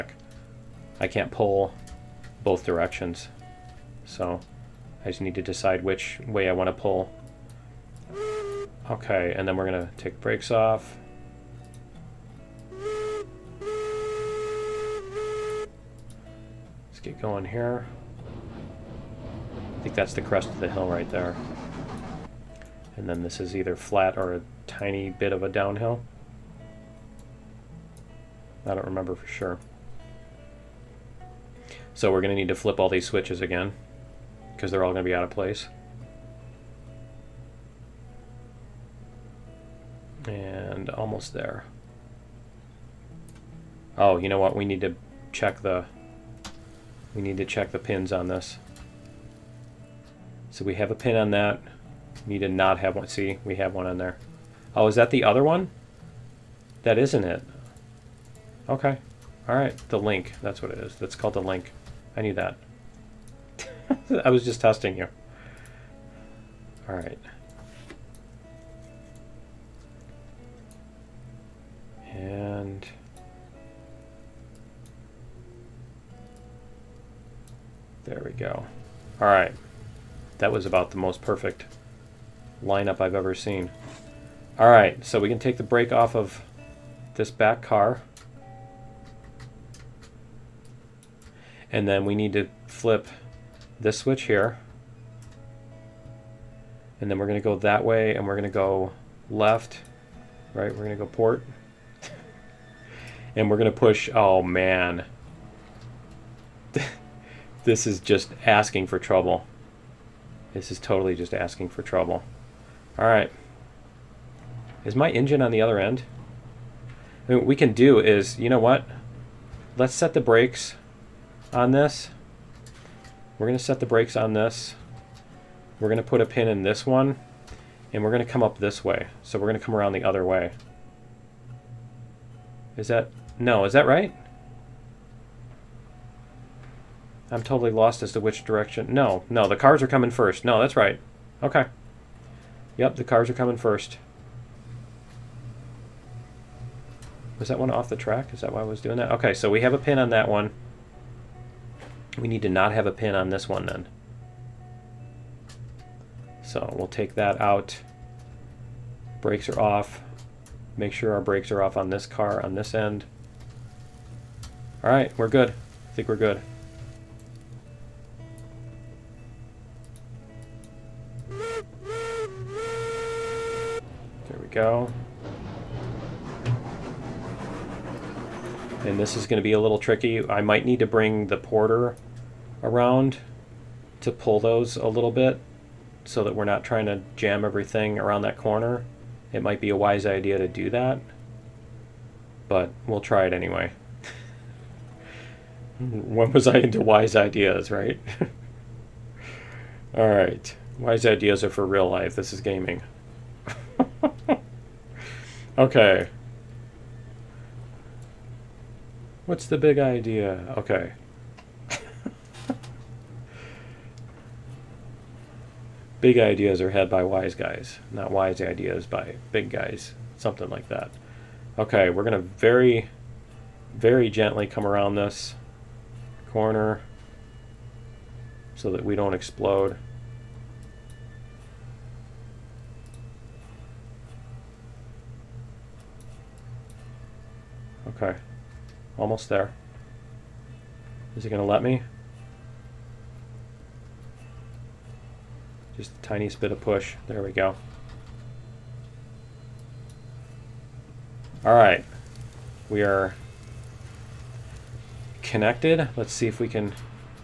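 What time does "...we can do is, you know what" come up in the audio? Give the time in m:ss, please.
1:57.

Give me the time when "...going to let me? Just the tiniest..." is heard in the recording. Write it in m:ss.
4:01.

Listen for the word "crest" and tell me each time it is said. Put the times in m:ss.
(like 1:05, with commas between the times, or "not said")
0:20.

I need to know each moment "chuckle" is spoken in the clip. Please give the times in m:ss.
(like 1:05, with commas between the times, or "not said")
not said.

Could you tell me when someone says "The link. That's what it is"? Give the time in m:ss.
0:59.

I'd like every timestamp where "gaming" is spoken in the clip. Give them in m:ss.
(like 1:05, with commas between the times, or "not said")
3:22.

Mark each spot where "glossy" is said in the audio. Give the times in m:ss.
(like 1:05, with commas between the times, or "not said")
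not said.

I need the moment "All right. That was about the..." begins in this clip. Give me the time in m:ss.
1:19.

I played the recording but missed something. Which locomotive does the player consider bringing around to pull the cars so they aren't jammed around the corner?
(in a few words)
The Porter.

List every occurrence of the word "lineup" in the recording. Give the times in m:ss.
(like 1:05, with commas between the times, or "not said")
1:22.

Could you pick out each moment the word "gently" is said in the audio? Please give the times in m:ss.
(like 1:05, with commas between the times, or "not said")
3:44.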